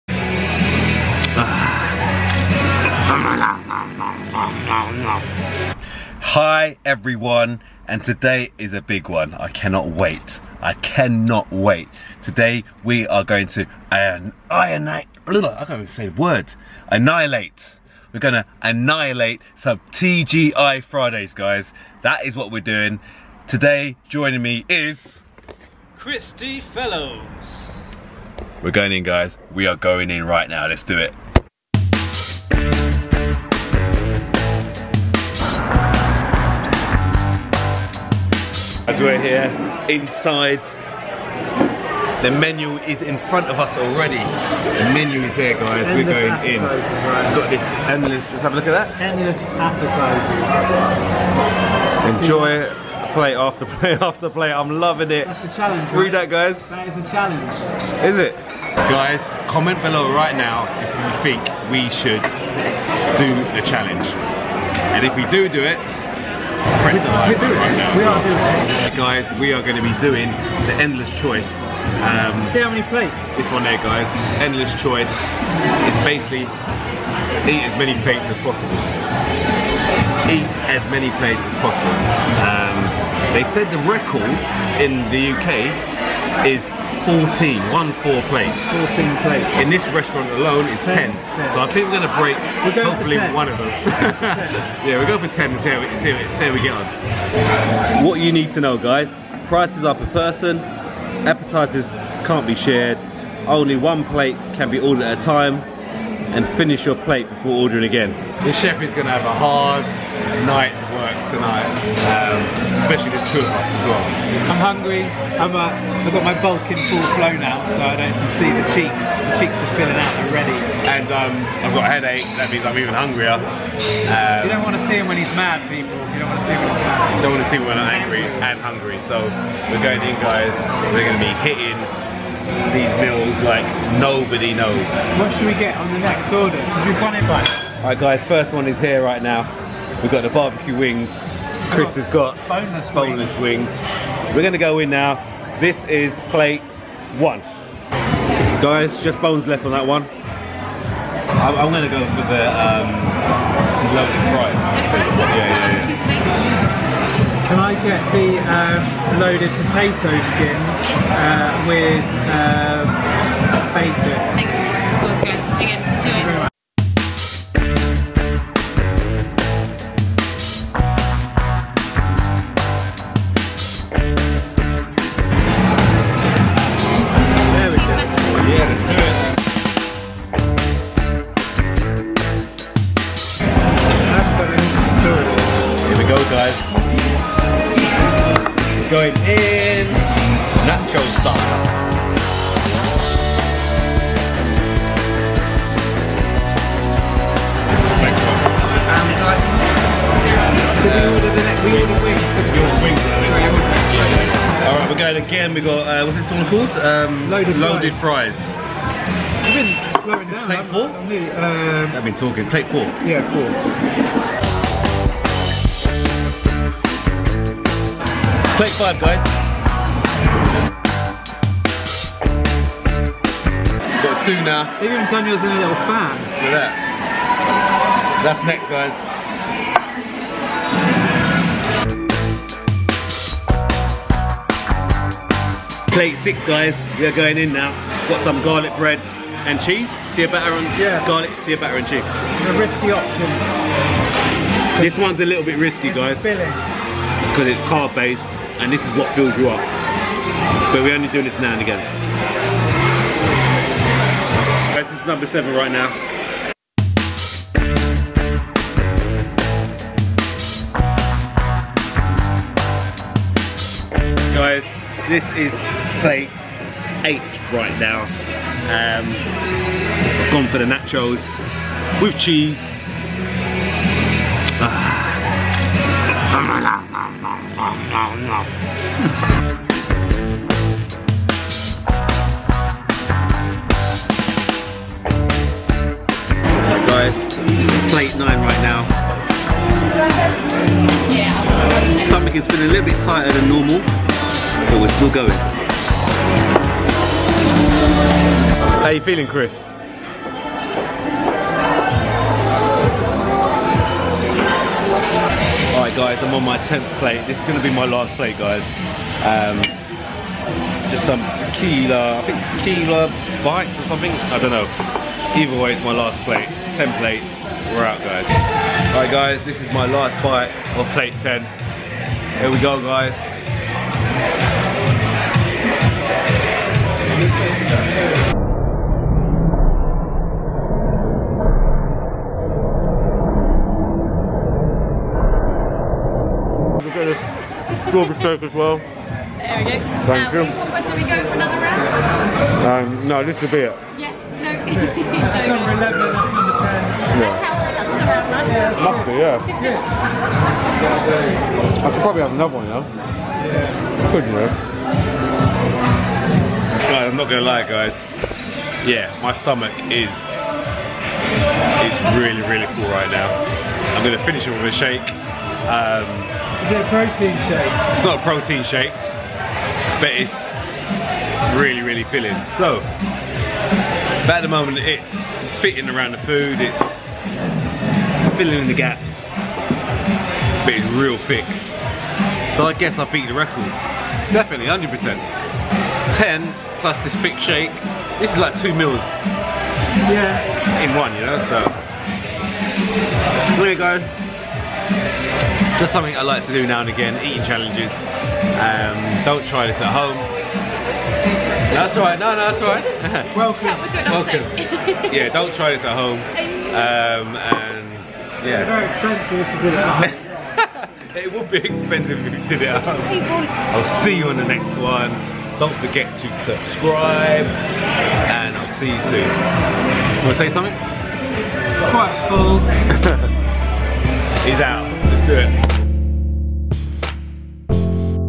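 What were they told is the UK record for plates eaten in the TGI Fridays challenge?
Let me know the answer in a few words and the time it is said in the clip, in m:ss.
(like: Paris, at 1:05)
14, at 1:27.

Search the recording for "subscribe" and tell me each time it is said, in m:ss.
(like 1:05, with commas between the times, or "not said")
6:56.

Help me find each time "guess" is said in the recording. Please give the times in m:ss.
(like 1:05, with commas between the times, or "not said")
6:22.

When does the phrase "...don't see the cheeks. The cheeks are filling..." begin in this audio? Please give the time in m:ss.
1:57.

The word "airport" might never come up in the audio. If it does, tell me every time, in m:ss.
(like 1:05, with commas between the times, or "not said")
not said.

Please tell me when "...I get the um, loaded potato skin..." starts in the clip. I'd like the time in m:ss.
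2:37.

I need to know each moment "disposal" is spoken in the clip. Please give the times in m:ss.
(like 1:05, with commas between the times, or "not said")
not said.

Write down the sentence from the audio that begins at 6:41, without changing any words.
That's right, no, no, that's right.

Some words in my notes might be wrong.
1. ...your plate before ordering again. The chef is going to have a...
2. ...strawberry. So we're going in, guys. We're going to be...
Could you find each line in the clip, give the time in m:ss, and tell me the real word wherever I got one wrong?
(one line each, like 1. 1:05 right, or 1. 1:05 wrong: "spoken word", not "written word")
1. 1:46 right
2. 2:08 wrong: "hungry", not "strawberry".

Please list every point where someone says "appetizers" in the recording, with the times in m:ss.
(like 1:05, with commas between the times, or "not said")
0:49, 1:41.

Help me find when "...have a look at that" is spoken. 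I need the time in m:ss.
0:48.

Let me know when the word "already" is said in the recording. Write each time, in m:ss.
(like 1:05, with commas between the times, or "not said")
0:43, 2:00.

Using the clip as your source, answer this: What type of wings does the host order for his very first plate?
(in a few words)
Barbecue wings.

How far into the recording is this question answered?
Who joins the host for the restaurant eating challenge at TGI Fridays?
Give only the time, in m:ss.
0:25.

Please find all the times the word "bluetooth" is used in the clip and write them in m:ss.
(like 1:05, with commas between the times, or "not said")
not said.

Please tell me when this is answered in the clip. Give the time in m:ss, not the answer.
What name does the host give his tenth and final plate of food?
5:12.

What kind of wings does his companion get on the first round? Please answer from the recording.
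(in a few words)
Boneless wings.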